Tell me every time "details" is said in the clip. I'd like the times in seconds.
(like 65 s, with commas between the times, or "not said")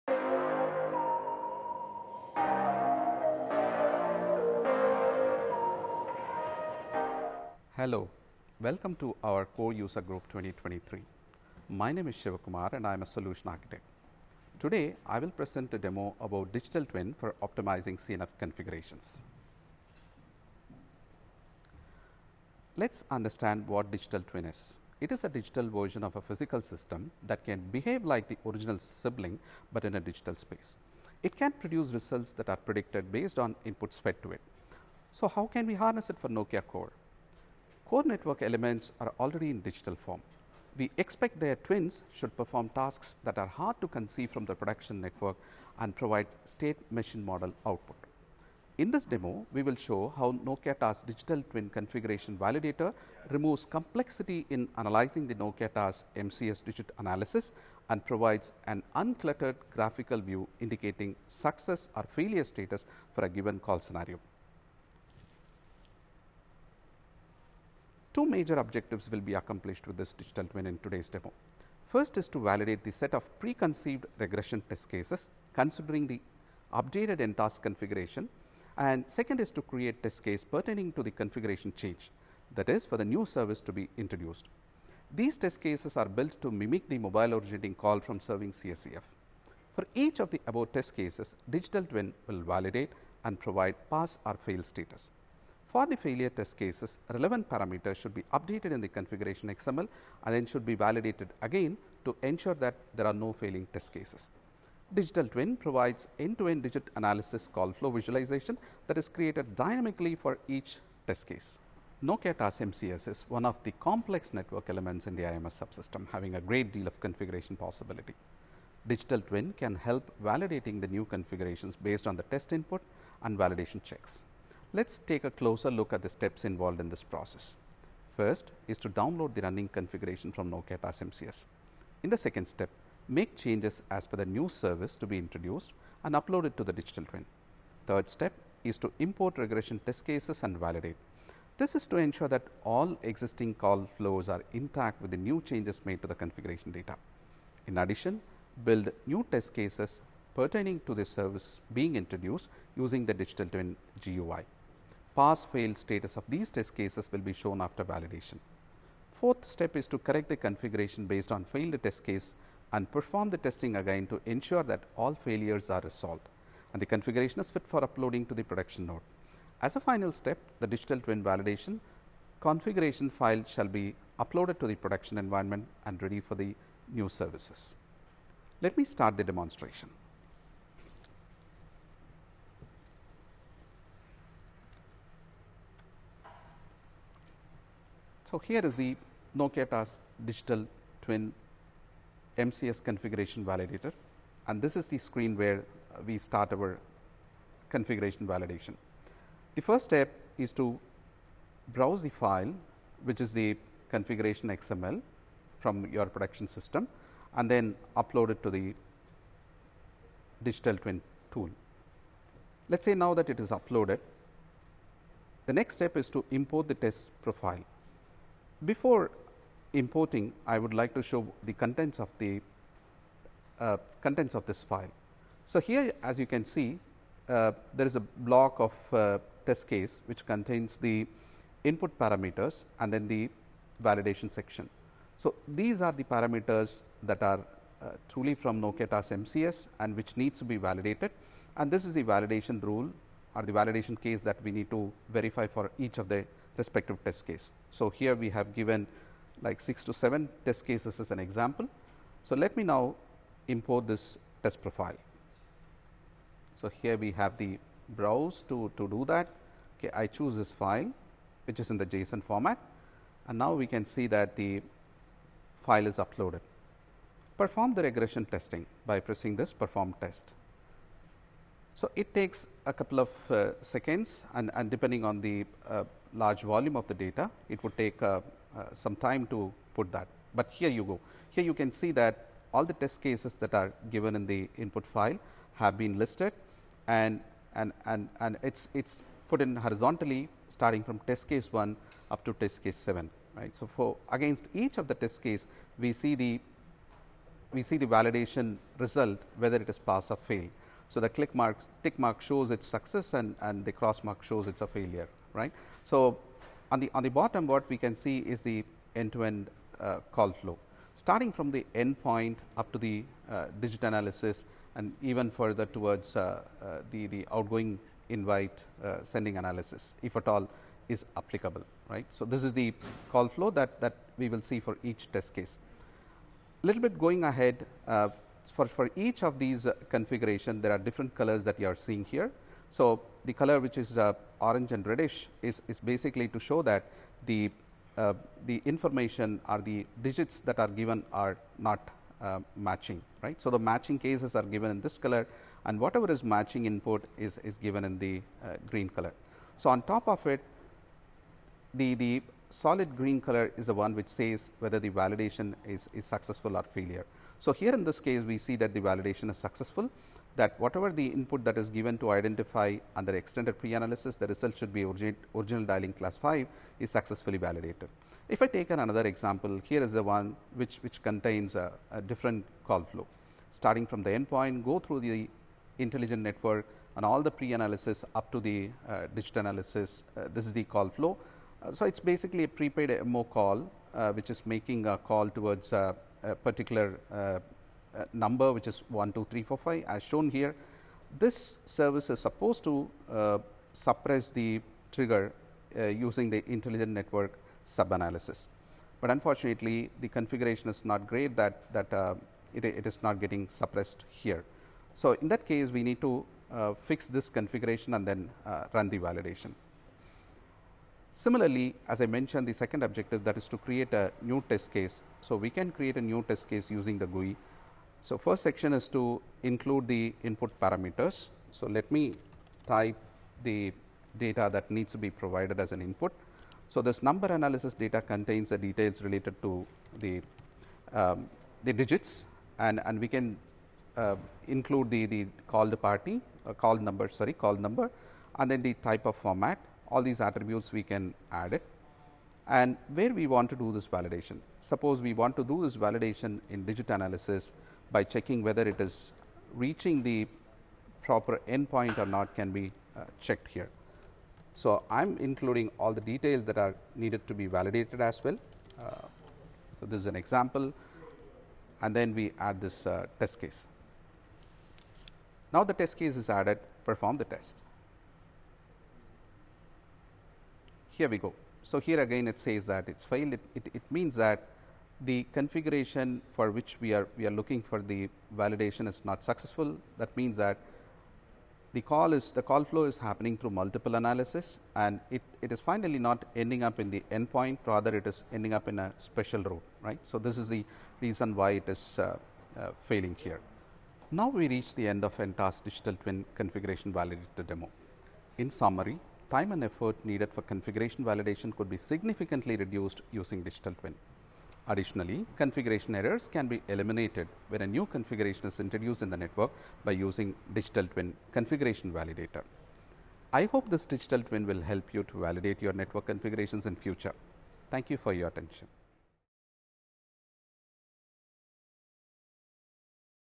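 428 s, 456 s.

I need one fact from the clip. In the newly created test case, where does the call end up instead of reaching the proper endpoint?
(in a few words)
A special route.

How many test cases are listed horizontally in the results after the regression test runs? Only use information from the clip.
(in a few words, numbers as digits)
7.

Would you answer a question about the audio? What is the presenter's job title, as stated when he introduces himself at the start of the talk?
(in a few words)
Solution architect.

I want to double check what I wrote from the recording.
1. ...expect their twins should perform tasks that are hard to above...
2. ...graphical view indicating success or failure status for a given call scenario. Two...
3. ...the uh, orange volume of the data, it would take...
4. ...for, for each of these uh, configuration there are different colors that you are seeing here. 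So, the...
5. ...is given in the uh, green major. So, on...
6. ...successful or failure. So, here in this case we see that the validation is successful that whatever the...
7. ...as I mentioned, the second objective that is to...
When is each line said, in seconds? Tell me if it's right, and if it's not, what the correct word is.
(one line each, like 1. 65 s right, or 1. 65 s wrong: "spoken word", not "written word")
1. 41 s wrong: "conceive", not "above"
2. 59 s right
3. 275 s wrong: "large", not "orange"
4. 328 s right
5. 347 s wrong: "color", not "major"
6. 356 s right
7. 411 s right.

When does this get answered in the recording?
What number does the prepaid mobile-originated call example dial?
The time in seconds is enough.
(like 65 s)
388 s.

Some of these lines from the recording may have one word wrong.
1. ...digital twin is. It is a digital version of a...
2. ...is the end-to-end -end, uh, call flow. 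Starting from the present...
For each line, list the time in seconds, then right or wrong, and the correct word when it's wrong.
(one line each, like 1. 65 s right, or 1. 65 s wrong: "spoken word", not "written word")
1. 23 s right
2. 308 s wrong: "endpoint", not "present".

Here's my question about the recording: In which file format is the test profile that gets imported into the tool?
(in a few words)
JSON.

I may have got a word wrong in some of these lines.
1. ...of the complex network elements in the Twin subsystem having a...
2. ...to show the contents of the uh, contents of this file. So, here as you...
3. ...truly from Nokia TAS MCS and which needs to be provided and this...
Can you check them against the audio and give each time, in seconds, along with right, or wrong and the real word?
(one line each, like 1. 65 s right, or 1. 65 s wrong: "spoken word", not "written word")
1. 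113 s wrong: "IMS", not "Twin"
2. 220 s right
3. 238 s wrong: "validated", not "provided".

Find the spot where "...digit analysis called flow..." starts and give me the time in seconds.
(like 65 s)
106 s.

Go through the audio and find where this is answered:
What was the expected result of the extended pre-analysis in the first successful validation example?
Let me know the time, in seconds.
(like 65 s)
365 s.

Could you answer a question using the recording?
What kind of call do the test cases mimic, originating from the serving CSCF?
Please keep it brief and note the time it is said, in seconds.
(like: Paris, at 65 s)
Mobile originating call, at 86 s.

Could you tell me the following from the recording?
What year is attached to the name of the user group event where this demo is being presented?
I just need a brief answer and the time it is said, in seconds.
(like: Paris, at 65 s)
2023, at 10 s.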